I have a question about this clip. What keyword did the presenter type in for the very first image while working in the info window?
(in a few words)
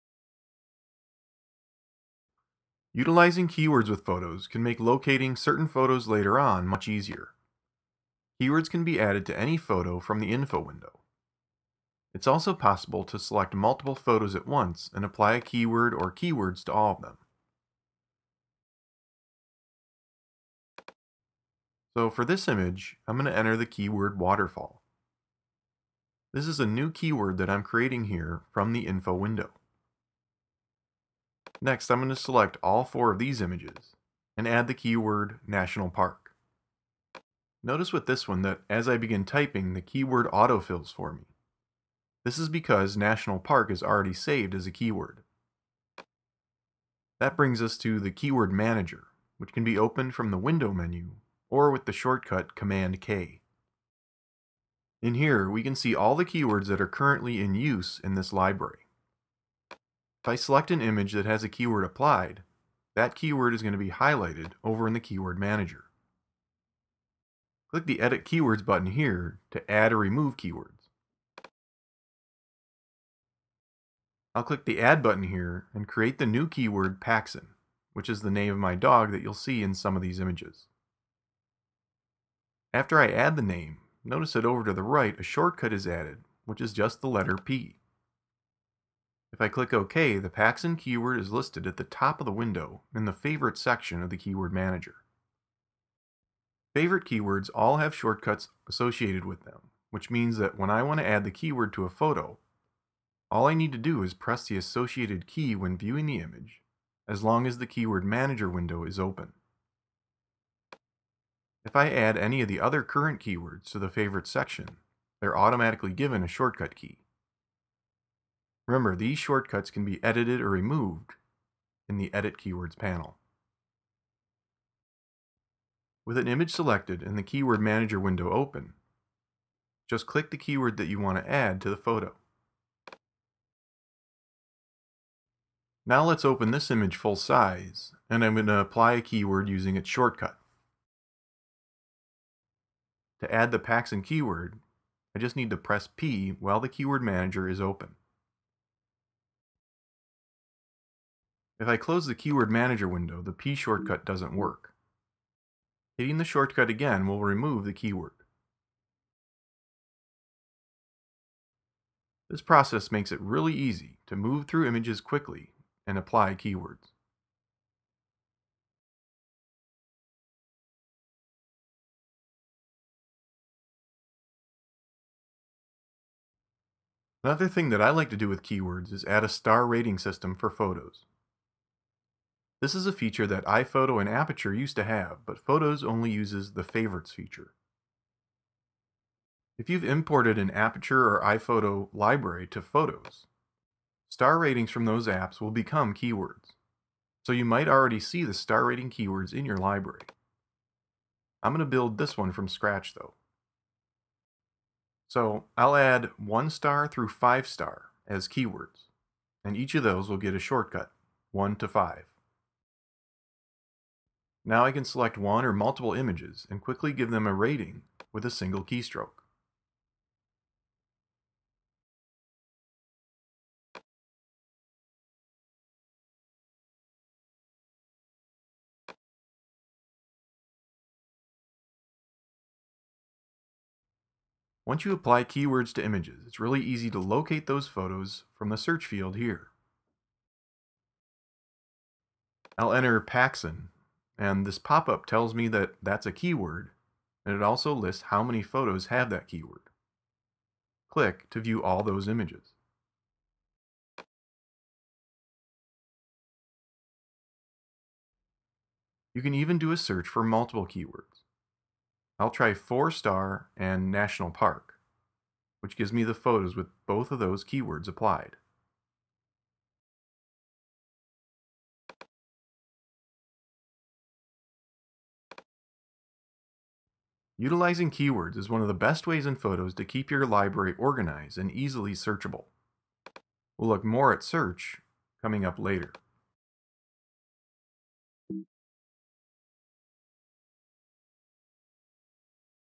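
waterfall.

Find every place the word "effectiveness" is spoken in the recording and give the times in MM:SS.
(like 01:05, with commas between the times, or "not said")
not said.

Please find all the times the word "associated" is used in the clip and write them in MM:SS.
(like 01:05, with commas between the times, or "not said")
01:38, 01:44.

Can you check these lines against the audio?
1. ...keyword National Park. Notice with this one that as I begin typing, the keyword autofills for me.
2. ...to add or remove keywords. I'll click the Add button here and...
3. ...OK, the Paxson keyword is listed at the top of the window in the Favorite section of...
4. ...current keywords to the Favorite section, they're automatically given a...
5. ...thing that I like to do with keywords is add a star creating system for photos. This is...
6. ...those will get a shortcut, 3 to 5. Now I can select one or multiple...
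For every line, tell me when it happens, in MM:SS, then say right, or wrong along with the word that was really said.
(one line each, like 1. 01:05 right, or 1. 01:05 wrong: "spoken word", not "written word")
1. 00:34 right
2. 01:09 right
3. 01:29 right
4. 01:52 right
5. 02:57 wrong: "rating", not "creating"
6. 03:29 wrong: "1", not "3".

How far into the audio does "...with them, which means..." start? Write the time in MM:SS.
01:39.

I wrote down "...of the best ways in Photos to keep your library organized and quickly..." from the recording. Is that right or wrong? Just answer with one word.
wrong.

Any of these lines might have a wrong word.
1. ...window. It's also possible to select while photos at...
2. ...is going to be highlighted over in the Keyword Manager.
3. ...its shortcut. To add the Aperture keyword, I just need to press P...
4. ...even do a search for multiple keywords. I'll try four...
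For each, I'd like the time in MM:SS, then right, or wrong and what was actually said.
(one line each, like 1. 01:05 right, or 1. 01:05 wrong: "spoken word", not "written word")
1. 00:10 wrong: "multiple", not "while"
2. 01:03 right
3. 02:19 wrong: "Paxson", not "Aperture"
4. 04:19 right.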